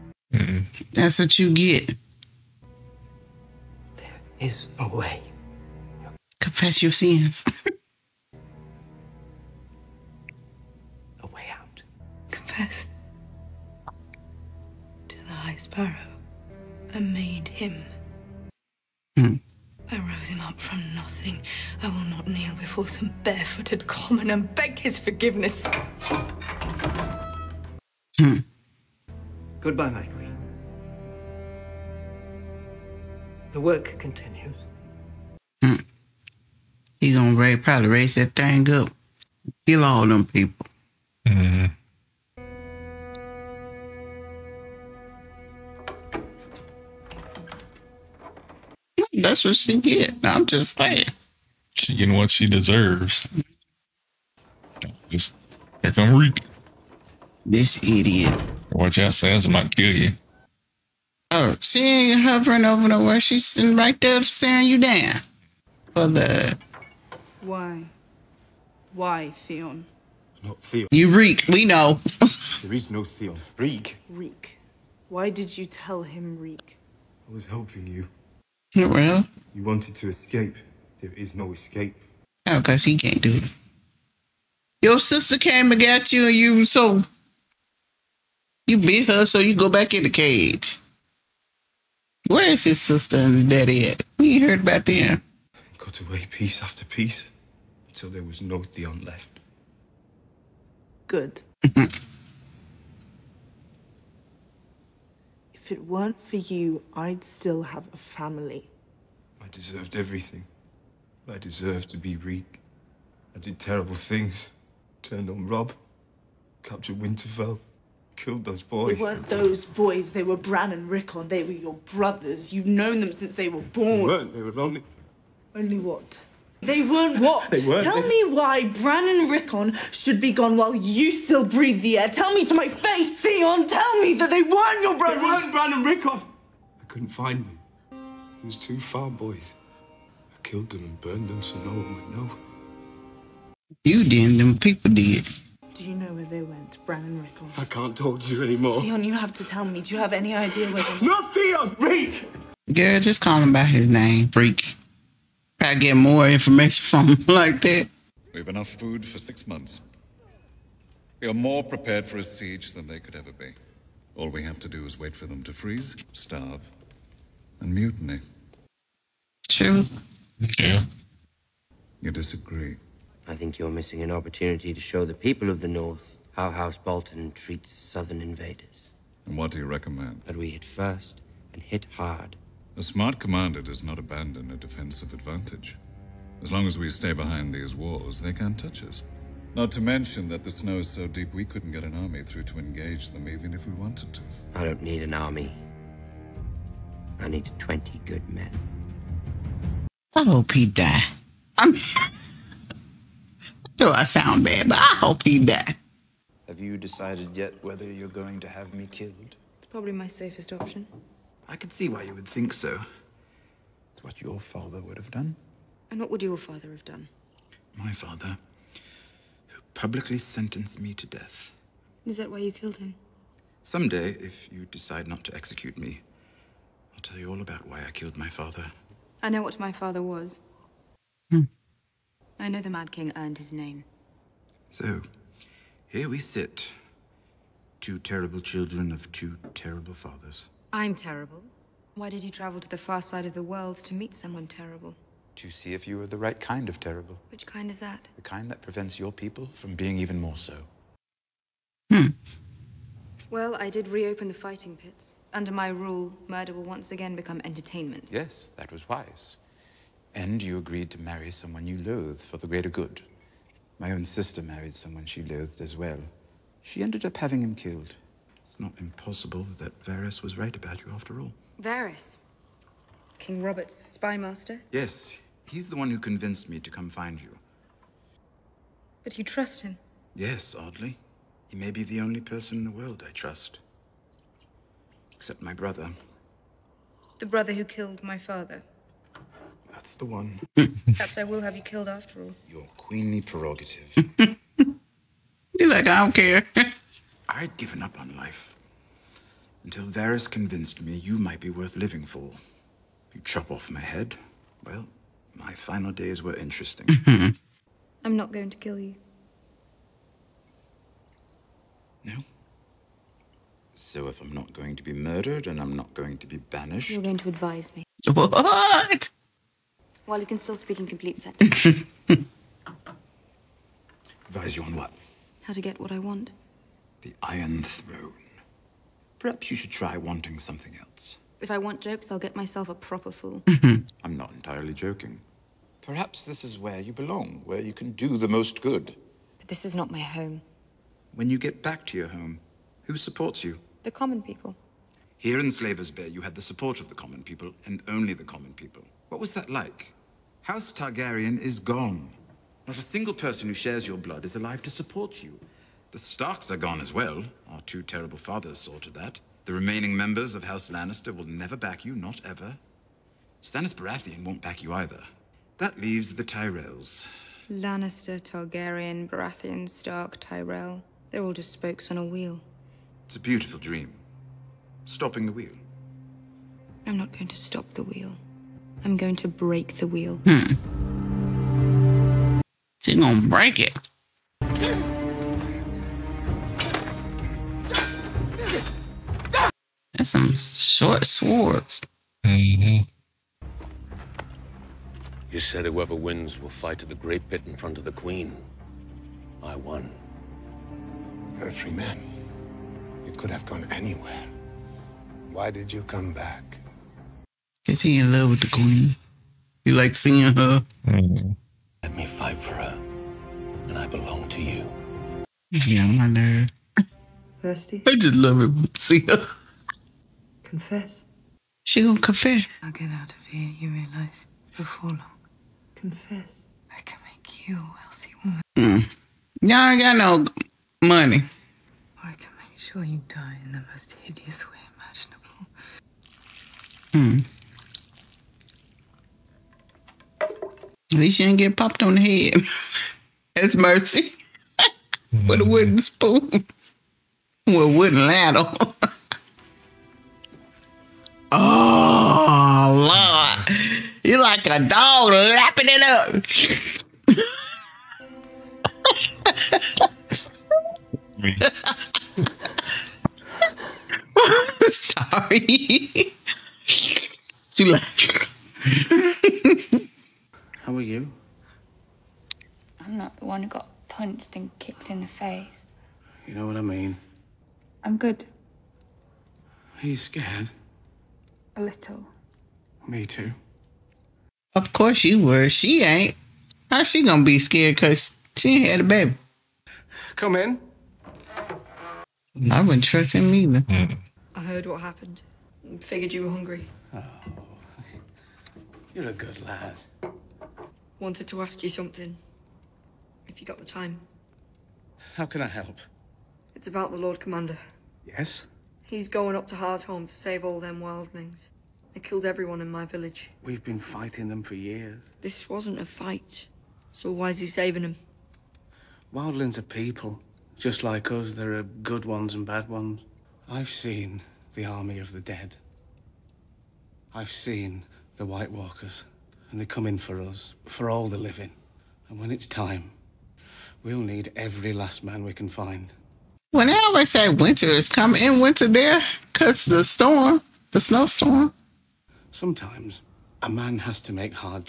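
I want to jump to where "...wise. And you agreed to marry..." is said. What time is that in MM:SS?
04:18.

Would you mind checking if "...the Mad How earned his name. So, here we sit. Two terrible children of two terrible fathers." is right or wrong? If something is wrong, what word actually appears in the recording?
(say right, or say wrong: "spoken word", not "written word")
wrong: "King", not "How".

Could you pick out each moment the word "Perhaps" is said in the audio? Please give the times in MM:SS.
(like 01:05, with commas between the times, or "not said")
04:50, 05:29, 05:35.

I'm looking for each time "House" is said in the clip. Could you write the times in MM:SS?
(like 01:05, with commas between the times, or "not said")
02:56, 05:50, 06:00.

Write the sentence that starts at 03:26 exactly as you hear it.
Have you decided yet whether you're going to have me killed?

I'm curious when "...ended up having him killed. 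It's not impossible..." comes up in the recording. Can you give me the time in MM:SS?
04:26.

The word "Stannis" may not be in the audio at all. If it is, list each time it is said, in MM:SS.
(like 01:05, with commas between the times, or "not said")
06:03.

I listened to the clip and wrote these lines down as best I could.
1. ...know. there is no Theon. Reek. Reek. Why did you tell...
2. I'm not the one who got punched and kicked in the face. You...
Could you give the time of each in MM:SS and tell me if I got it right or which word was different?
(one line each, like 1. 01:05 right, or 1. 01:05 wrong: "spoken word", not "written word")
1. 01:11 right
2. 07:52 right.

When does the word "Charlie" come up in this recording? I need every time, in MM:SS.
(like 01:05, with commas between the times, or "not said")
not said.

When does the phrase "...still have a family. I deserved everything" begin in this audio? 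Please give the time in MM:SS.
01:47.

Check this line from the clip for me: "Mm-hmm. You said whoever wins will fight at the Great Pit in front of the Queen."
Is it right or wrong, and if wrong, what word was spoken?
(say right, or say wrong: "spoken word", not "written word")
right.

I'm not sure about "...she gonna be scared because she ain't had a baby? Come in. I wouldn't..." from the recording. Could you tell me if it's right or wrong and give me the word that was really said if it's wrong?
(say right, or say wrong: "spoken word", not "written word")
right.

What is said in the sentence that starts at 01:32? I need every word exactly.
Where is his sister and daddy at?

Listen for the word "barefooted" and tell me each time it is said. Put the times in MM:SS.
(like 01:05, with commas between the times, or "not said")
00:23.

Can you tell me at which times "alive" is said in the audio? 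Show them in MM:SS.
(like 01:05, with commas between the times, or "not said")
05:54.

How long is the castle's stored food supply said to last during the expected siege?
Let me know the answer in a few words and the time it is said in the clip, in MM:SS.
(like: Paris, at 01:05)
six months, at 02:39.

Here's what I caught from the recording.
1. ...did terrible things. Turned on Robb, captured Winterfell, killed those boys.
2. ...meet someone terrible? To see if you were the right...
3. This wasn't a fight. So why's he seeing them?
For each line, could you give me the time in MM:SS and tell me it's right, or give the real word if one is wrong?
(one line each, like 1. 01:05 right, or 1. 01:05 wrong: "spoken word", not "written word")
1. 01:53 right
2. 04:03 right
3. 08:35 wrong: "saving", not "seeing".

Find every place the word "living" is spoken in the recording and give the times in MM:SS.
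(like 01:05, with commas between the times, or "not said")
05:01, 08:51.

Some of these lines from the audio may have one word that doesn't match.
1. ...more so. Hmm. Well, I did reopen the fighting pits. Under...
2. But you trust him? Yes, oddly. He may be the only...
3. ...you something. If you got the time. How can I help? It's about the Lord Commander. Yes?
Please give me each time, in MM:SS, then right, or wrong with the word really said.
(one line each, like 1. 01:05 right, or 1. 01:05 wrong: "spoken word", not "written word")
1. 04:10 right
2. 04:39 right
3. 08:21 right.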